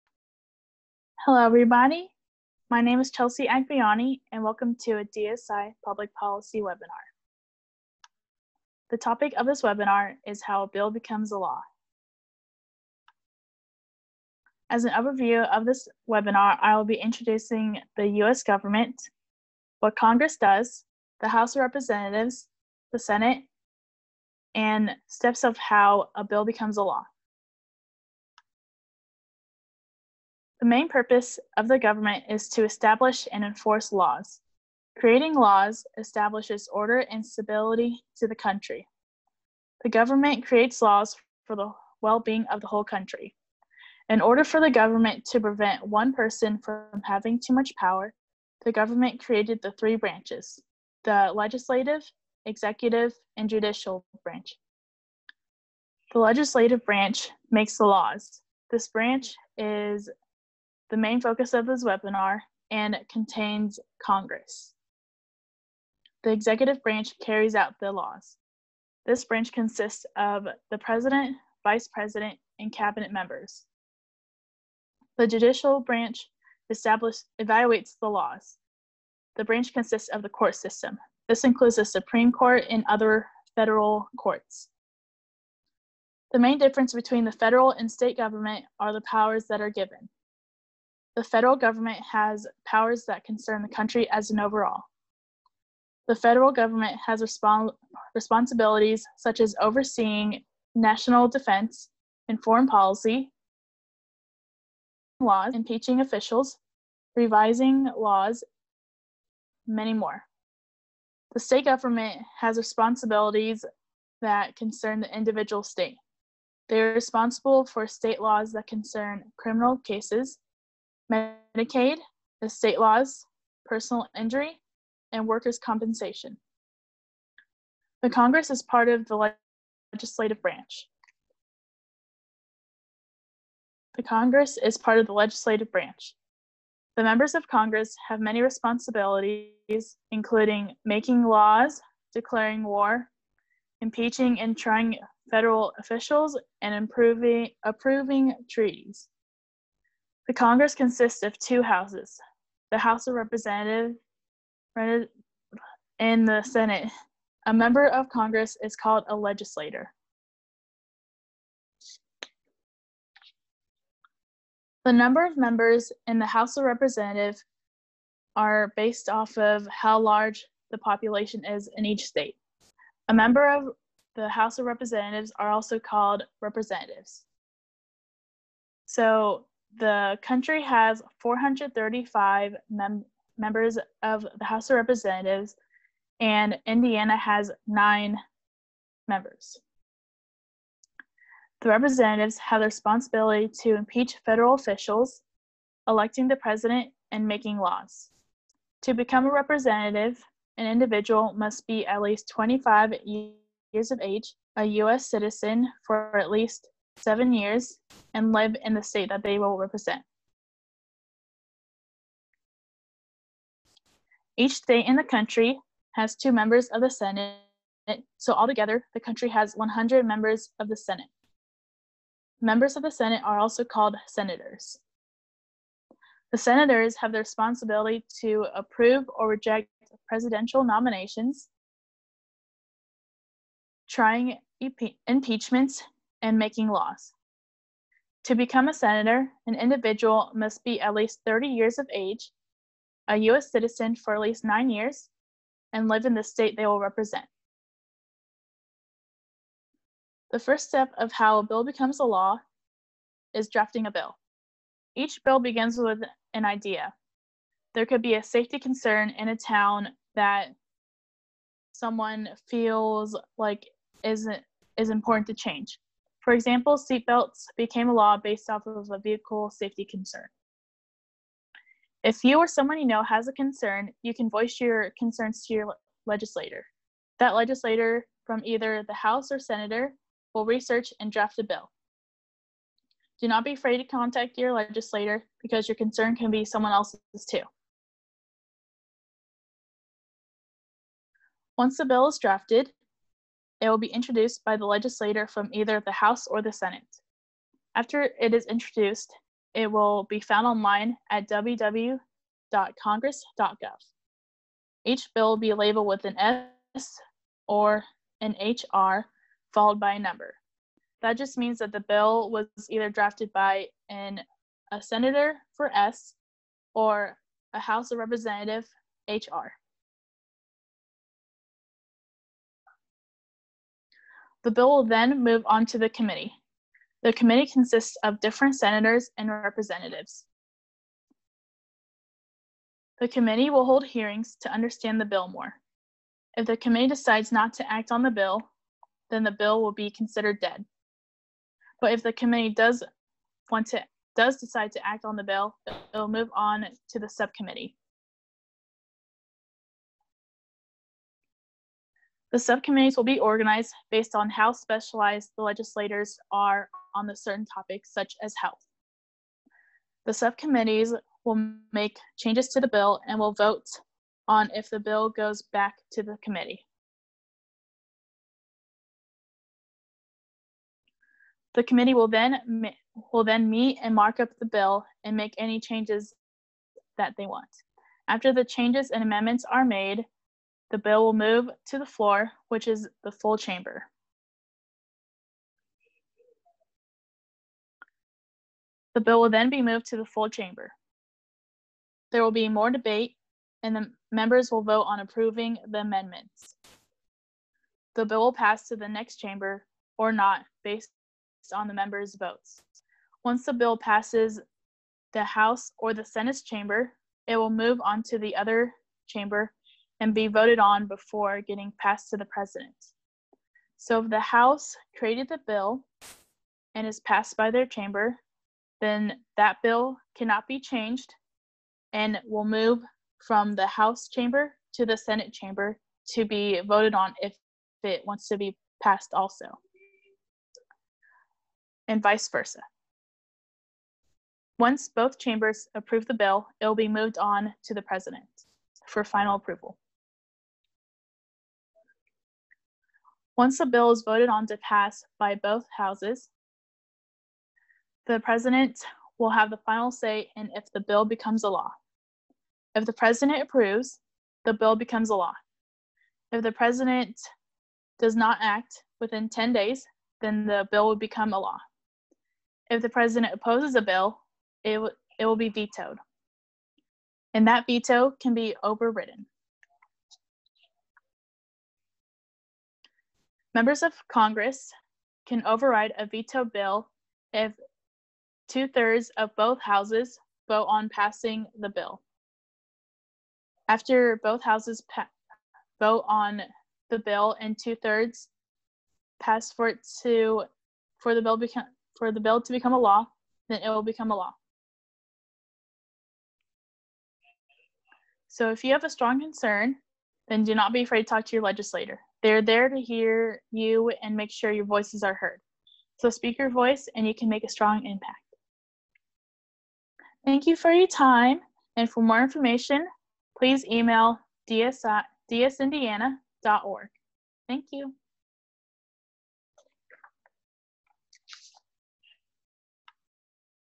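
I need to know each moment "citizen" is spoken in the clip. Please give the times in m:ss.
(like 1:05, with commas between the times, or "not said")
3:25, 4:03.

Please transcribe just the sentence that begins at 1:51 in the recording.
The state government has responsibilities that concern the individual state.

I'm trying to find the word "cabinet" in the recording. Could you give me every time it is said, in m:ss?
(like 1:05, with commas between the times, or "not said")
1:12.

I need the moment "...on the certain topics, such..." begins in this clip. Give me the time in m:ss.
5:56.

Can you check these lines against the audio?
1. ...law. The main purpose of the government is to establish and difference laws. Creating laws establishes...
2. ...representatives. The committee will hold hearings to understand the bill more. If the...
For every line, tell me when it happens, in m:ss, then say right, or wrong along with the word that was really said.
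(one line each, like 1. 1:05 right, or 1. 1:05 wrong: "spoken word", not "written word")
1. 0:26 wrong: "enforce", not "difference"
2. 5:29 right.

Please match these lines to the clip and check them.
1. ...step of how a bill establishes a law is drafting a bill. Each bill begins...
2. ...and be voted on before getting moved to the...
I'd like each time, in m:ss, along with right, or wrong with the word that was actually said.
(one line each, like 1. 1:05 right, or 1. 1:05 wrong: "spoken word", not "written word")
1. 4:10 wrong: "becomes", not "establishes"
2. 6:50 wrong: "passed", not "moved".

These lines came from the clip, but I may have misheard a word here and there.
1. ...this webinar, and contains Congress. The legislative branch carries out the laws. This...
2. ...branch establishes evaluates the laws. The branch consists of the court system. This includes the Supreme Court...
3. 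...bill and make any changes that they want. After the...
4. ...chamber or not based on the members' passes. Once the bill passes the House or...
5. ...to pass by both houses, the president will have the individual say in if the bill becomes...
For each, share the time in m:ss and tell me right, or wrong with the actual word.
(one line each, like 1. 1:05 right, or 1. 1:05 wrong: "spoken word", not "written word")
1. 1:01 wrong: "executive", not "legislative"
2. 1:15 right
3. 6:14 right
4. 6:39 wrong: "votes", not "passes"
5. 7:24 wrong: "final", not "individual".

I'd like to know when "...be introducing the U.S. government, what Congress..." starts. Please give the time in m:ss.
0:16.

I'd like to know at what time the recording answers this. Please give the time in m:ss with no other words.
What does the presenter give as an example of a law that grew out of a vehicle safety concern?
4:26.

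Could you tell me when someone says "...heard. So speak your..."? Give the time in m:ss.
8:25.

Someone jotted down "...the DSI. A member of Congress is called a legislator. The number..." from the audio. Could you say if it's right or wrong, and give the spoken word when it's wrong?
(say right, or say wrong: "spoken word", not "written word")
wrong: "Senate", not "DSI".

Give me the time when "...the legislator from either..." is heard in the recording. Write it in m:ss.
4:54.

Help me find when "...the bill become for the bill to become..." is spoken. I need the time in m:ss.
8:11.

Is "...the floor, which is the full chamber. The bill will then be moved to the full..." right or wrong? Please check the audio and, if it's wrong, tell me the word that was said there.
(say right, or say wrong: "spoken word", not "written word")
right.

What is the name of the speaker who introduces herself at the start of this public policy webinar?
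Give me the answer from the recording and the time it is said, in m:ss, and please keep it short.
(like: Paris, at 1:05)
Chelsea Agbiani, at 0:03.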